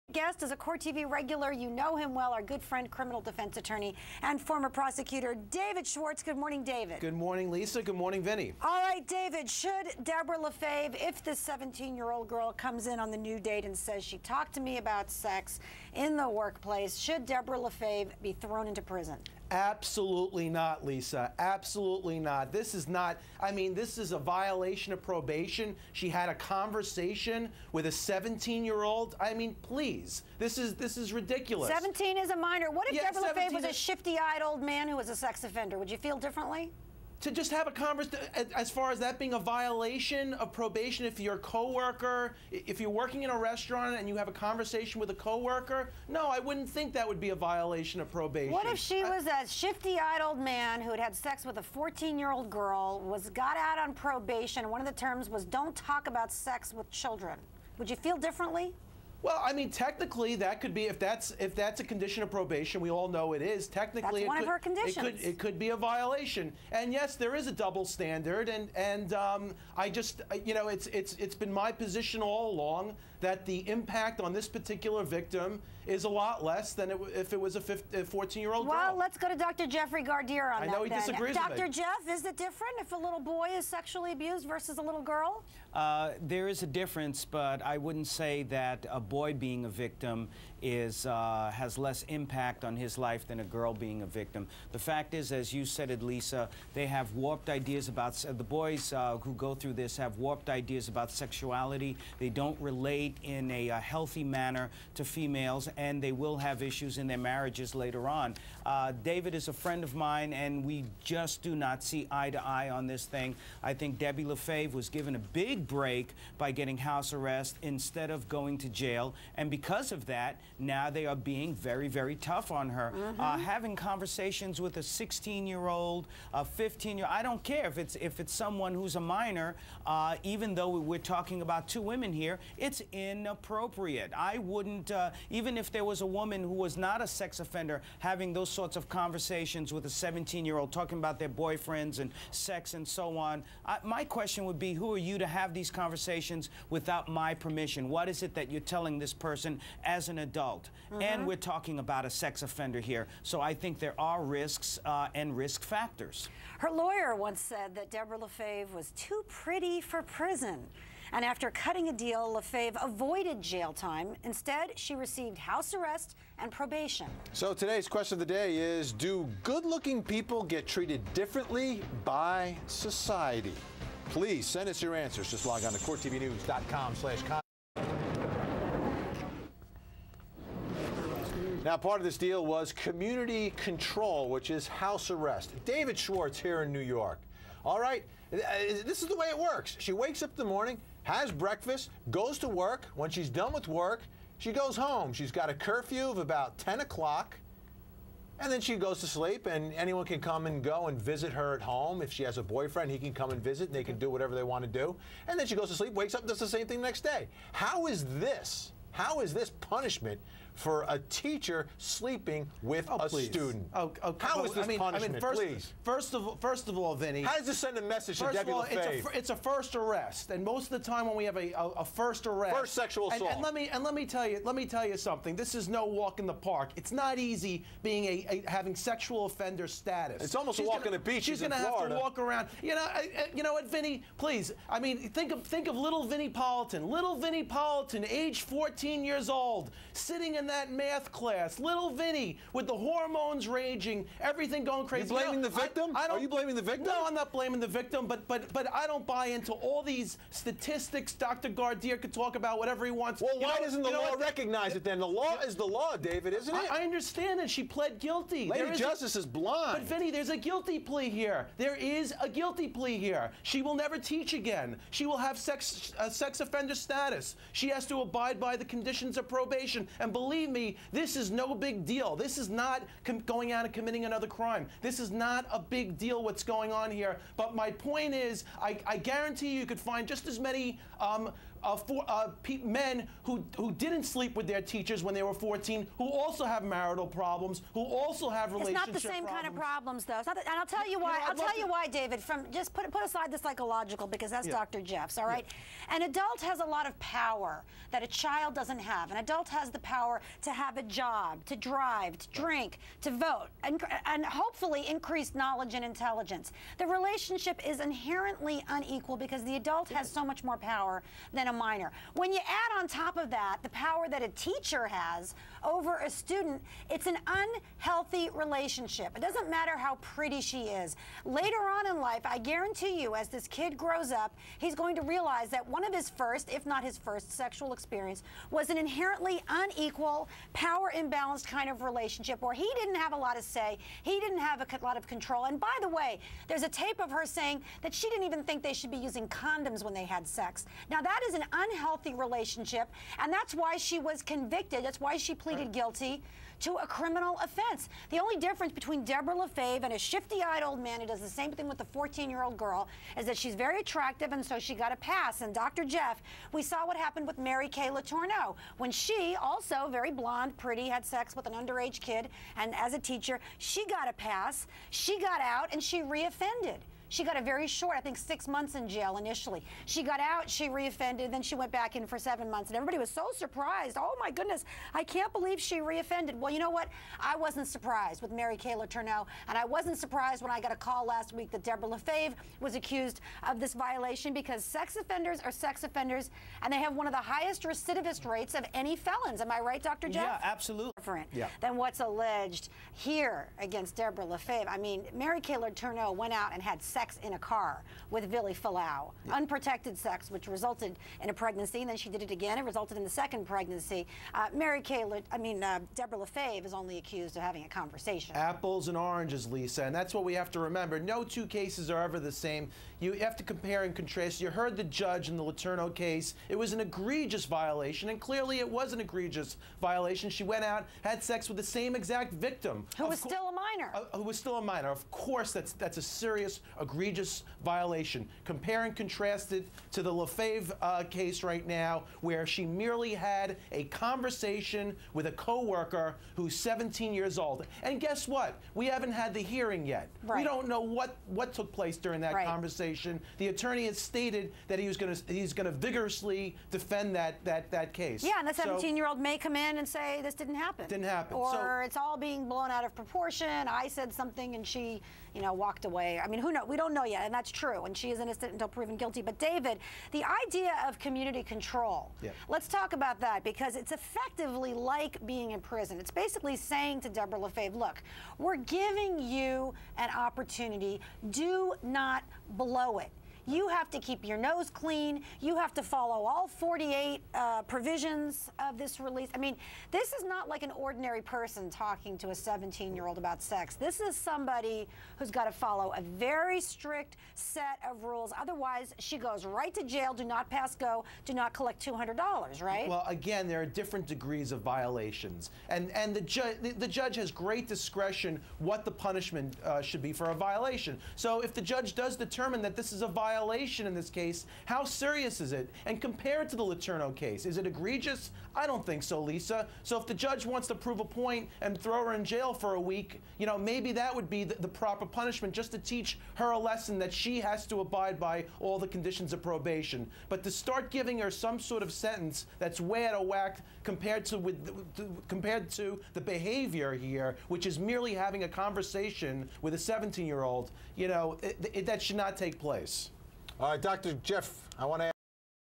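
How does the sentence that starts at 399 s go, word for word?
unprotected sex, which resulted in a pregnancy, and then she did it again.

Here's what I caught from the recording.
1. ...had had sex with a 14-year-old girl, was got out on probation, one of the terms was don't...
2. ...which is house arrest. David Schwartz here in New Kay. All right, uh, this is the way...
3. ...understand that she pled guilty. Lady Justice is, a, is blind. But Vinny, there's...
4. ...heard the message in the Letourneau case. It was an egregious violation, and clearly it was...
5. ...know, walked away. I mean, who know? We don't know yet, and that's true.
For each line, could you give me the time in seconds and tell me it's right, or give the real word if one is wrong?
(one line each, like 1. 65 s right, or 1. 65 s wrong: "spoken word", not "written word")
1. 50 s right
2. 184 s wrong: "York", not "Kay"
3. 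256 s right
4. 414 s wrong: "judge", not "message"
5. 455 s right.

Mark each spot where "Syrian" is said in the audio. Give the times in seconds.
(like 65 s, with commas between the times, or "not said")
not said.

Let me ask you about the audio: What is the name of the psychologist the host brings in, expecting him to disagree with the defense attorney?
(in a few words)
Jeffrey Gardere.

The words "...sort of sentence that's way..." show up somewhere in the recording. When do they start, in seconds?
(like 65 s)
521 s.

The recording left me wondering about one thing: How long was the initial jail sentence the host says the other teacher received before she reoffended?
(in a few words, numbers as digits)
6 months.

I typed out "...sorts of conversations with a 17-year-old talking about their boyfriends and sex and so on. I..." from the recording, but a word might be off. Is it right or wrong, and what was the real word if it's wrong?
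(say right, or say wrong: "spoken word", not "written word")
right.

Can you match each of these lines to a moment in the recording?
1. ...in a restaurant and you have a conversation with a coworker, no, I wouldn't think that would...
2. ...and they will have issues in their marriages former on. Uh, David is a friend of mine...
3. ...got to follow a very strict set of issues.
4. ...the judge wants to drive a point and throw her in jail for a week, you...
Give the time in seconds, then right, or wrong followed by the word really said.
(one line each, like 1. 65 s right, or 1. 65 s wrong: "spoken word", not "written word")
1. 43 s right
2. 105 s wrong: "later", not "former"
3. 485 s wrong: "rules", not "issues"
4. 510 s wrong: "prove", not "drive".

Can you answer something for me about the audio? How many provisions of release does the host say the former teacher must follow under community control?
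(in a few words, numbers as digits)
48.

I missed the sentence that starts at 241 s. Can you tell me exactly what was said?
Little Vinny with the hormones raging, everything going crazy.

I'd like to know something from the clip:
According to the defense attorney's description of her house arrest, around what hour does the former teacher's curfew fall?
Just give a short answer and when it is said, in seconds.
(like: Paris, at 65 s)
10 o'clock, at 196 s.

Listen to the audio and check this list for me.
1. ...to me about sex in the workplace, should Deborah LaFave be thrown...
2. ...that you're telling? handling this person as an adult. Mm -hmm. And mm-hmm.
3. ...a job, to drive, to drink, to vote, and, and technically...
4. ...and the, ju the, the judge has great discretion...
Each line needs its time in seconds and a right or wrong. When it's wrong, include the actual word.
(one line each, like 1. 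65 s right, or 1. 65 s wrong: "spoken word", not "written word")
1. 14 s right
2. 148 s right
3. 300 s wrong: "hopefully", not "technically"
4. 495 s right.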